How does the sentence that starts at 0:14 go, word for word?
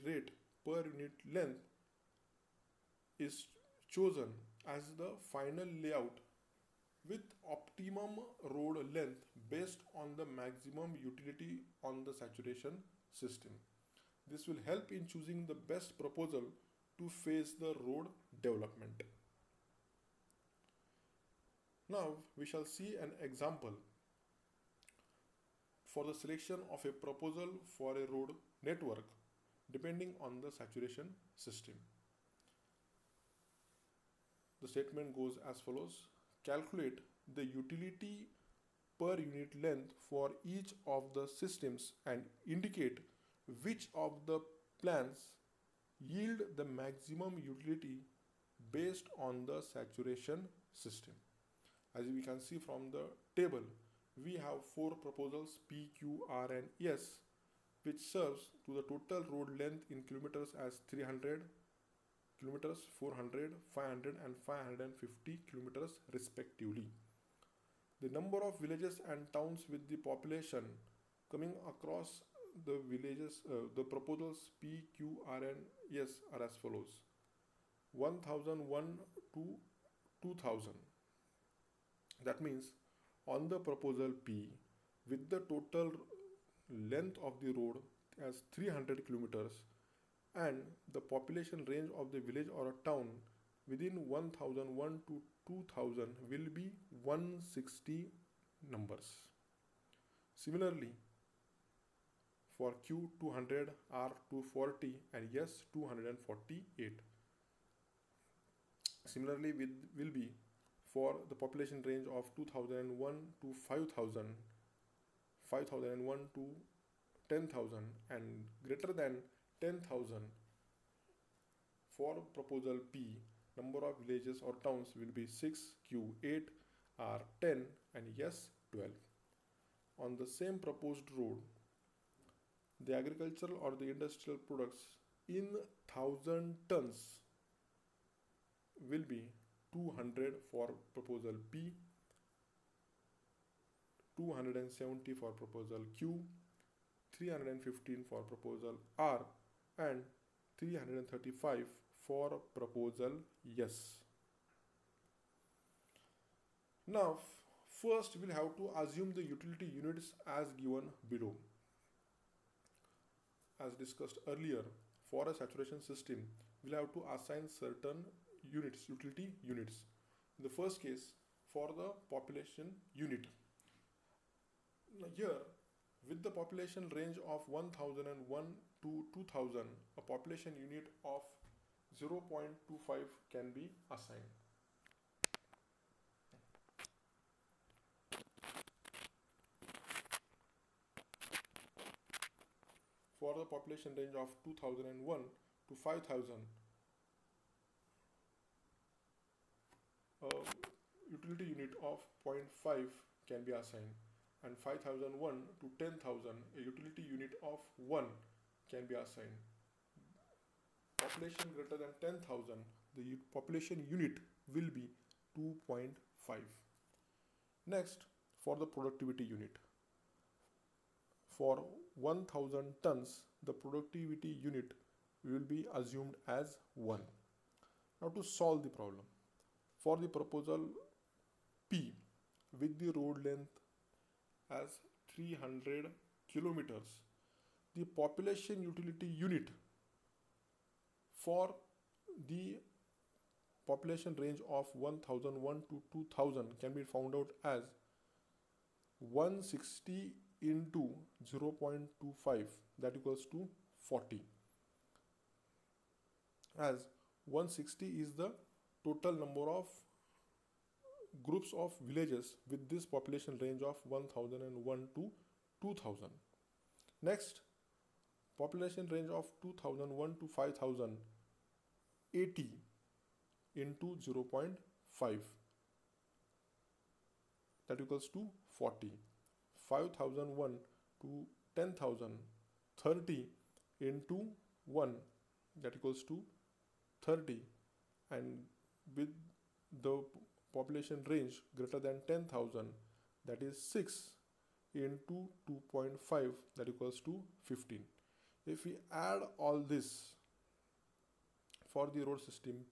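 This will help in choosing the best proposal to face the road development.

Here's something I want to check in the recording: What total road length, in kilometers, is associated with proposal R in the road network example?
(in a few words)
500.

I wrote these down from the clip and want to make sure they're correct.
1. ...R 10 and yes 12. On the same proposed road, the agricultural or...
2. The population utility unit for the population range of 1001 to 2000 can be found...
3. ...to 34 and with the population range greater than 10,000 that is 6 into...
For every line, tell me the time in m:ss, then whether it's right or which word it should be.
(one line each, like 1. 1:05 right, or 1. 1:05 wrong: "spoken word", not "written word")
1. 2:06 right
2. 3:57 right
3. 4:46 wrong: "30", not "34".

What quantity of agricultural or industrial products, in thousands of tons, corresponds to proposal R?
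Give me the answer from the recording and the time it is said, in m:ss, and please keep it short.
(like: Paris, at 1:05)
315, at 2:27.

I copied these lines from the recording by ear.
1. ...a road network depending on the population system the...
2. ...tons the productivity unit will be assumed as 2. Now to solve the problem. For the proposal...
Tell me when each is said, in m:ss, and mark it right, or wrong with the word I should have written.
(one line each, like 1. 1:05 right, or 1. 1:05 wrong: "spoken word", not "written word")
1. 0:27 wrong: "saturation", not "population"
2. 3:42 wrong: "1", not "2".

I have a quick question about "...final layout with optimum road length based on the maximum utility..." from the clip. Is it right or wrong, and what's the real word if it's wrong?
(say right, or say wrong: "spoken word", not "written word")
right.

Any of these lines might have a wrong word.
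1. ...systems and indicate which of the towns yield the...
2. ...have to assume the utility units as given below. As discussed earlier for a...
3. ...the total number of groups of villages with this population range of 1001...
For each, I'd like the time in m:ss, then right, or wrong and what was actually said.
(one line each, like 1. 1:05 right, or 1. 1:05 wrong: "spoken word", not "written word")
1. 0:41 wrong: "plans", not "towns"
2. 2:38 right
3. 4:18 right.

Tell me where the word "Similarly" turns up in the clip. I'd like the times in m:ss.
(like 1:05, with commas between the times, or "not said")
1:40, 1:49.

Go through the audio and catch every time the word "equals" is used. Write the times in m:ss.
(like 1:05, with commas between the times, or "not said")
4:12, 4:37, 4:45, 4:56.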